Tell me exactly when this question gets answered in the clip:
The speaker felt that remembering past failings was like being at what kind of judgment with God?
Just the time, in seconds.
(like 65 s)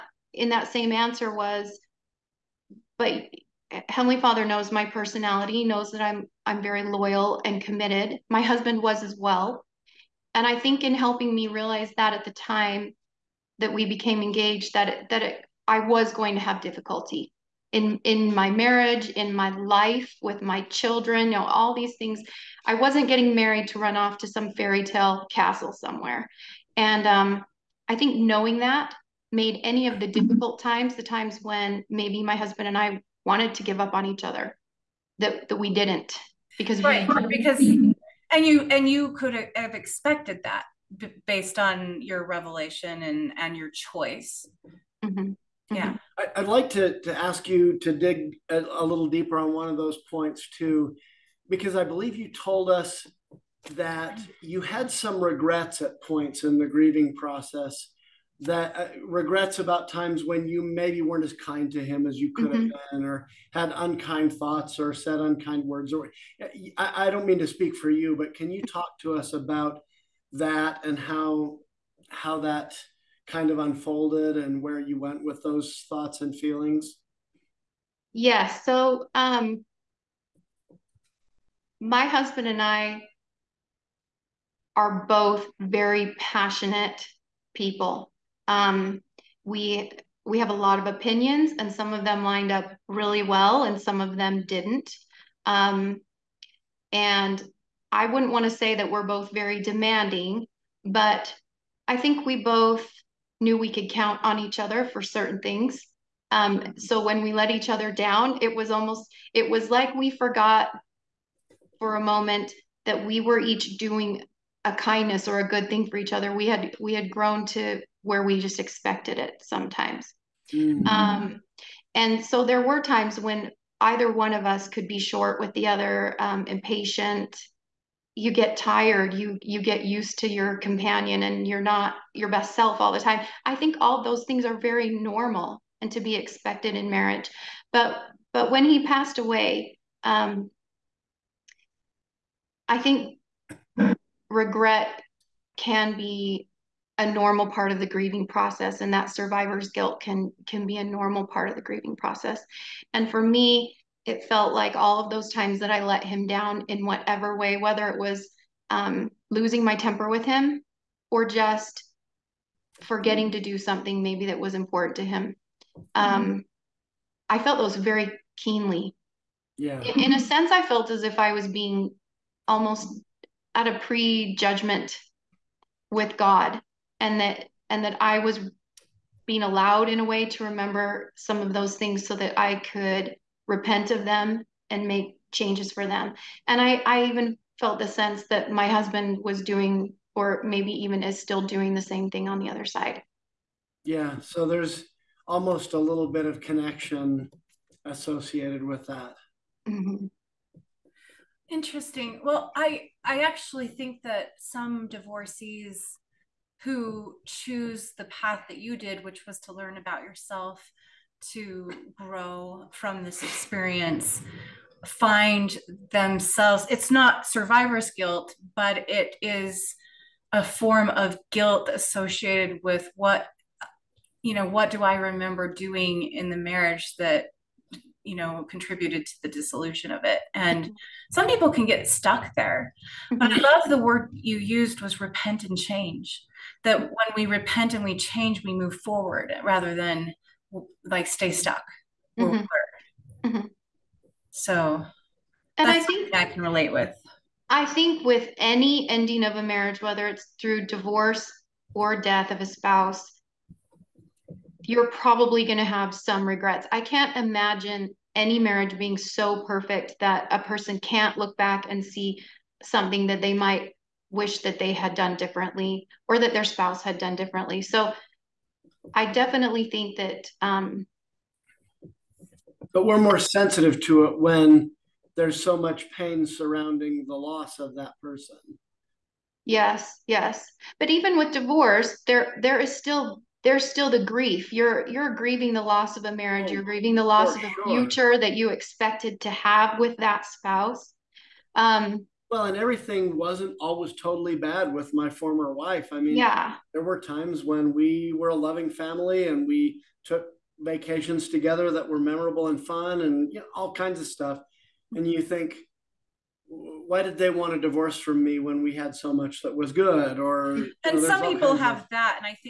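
173 s.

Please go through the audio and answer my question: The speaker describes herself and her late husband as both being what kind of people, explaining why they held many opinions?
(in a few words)
passionate.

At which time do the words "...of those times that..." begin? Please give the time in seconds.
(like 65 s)
155 s.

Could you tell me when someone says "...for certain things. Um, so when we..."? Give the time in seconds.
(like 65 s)
104 s.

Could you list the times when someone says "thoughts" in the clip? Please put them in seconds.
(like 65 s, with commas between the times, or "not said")
64 s, 75 s.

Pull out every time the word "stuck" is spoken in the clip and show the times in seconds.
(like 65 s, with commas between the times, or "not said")
231 s, 241 s.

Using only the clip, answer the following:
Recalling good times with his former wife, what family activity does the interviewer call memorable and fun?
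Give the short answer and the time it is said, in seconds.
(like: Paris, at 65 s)
vacations, at 300 s.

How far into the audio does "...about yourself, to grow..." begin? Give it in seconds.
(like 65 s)
209 s.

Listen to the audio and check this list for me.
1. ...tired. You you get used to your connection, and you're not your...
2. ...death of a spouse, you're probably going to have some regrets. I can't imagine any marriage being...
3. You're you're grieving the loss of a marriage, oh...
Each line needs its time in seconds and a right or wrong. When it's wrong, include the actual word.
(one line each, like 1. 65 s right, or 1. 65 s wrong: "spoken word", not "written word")
1. 128 s wrong: "companion", not "connection"
2. 251 s right
3. 284 s right.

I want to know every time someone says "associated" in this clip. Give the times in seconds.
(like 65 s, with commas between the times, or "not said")
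197 s, 221 s.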